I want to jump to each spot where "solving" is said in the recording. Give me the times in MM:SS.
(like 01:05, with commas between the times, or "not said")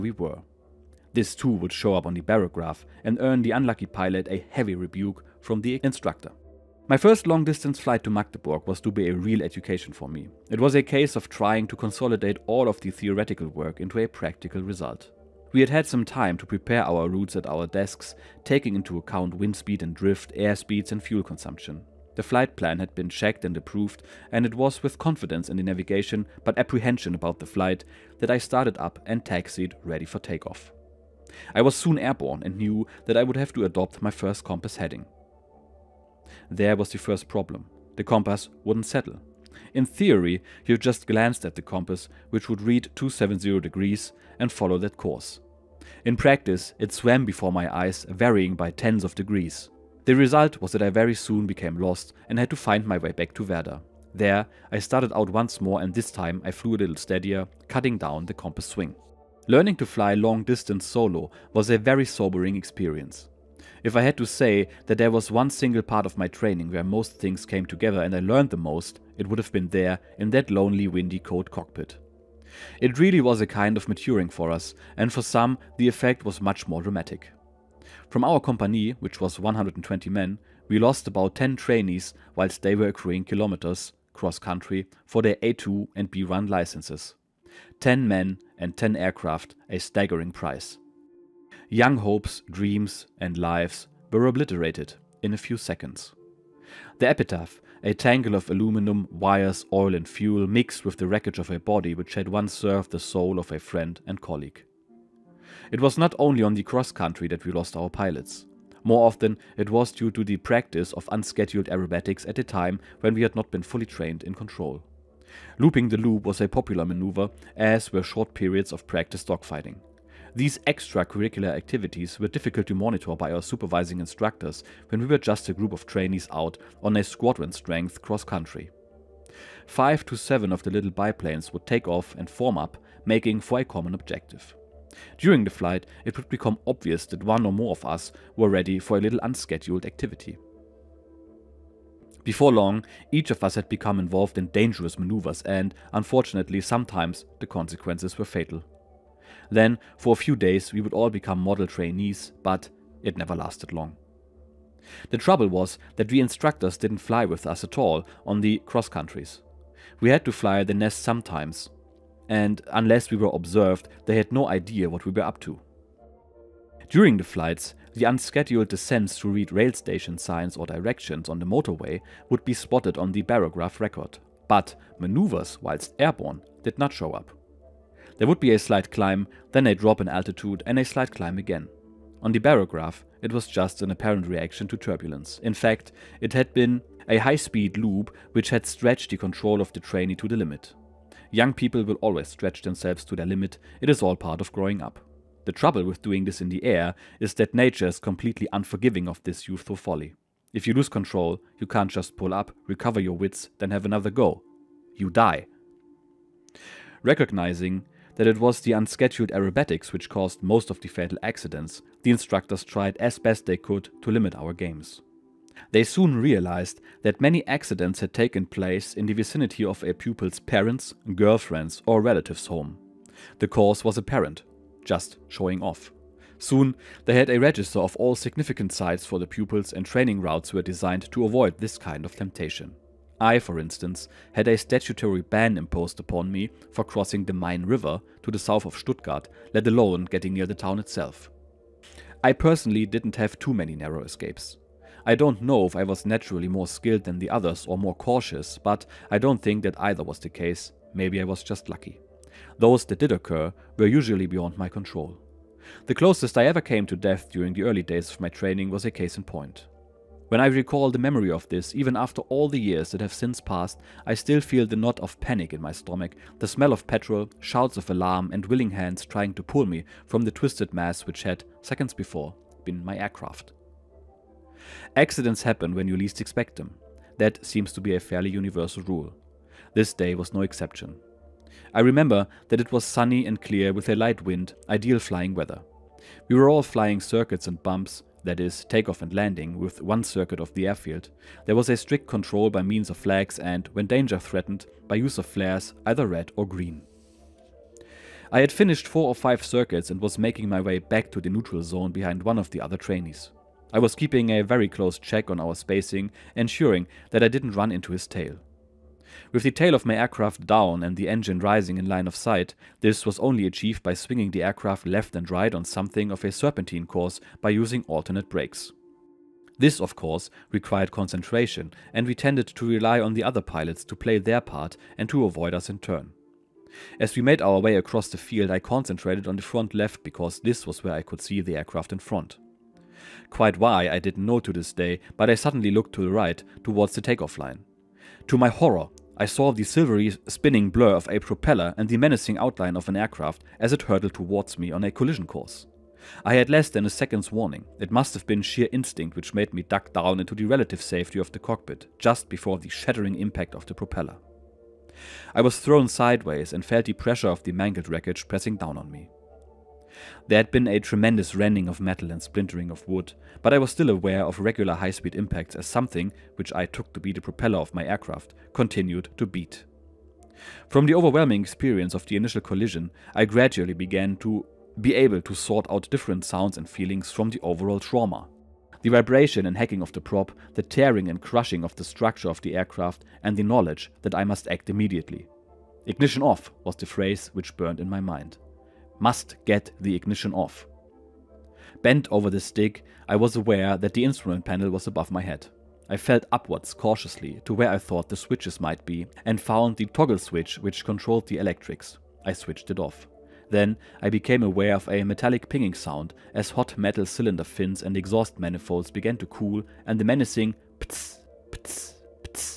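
not said.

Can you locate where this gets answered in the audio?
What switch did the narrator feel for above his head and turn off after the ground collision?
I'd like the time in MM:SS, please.
06:39.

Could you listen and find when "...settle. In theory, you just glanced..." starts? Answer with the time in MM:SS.
00:38.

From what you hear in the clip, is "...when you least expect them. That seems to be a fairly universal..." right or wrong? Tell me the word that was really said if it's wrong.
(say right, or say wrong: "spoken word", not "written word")
right.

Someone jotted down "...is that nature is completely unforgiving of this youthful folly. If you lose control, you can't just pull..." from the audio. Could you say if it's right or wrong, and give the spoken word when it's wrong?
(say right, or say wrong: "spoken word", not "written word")
right.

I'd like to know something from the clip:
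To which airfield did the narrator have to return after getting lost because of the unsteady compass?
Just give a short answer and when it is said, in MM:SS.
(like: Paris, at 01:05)
Werder, at 00:53.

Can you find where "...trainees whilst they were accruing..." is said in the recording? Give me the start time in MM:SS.
01:21.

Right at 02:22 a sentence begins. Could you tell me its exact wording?
Before long, each of us had become involved in dangerous maneuvers and, unfortunately, sometimes the consequences were fatal.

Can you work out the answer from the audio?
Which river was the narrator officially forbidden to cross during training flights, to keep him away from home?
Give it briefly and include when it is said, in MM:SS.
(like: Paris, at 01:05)
Main River, at 03:57.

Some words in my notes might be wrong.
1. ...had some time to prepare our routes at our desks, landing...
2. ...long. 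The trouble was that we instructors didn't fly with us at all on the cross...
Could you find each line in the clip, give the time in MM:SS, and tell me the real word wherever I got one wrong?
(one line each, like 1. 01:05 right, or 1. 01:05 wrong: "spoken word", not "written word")
1. 00:15 wrong: "taking", not "landing"
2. 02:33 right.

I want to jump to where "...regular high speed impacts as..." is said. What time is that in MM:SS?
06:04.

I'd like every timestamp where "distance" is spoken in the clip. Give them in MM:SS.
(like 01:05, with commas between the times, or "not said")
00:07, 01:00.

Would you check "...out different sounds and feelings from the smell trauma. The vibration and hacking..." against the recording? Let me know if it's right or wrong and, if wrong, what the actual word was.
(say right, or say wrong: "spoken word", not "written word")
wrong: "overall", not "smell".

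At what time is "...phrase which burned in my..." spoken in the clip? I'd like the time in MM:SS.
06:26.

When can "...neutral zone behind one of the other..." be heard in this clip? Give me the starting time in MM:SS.
05:01.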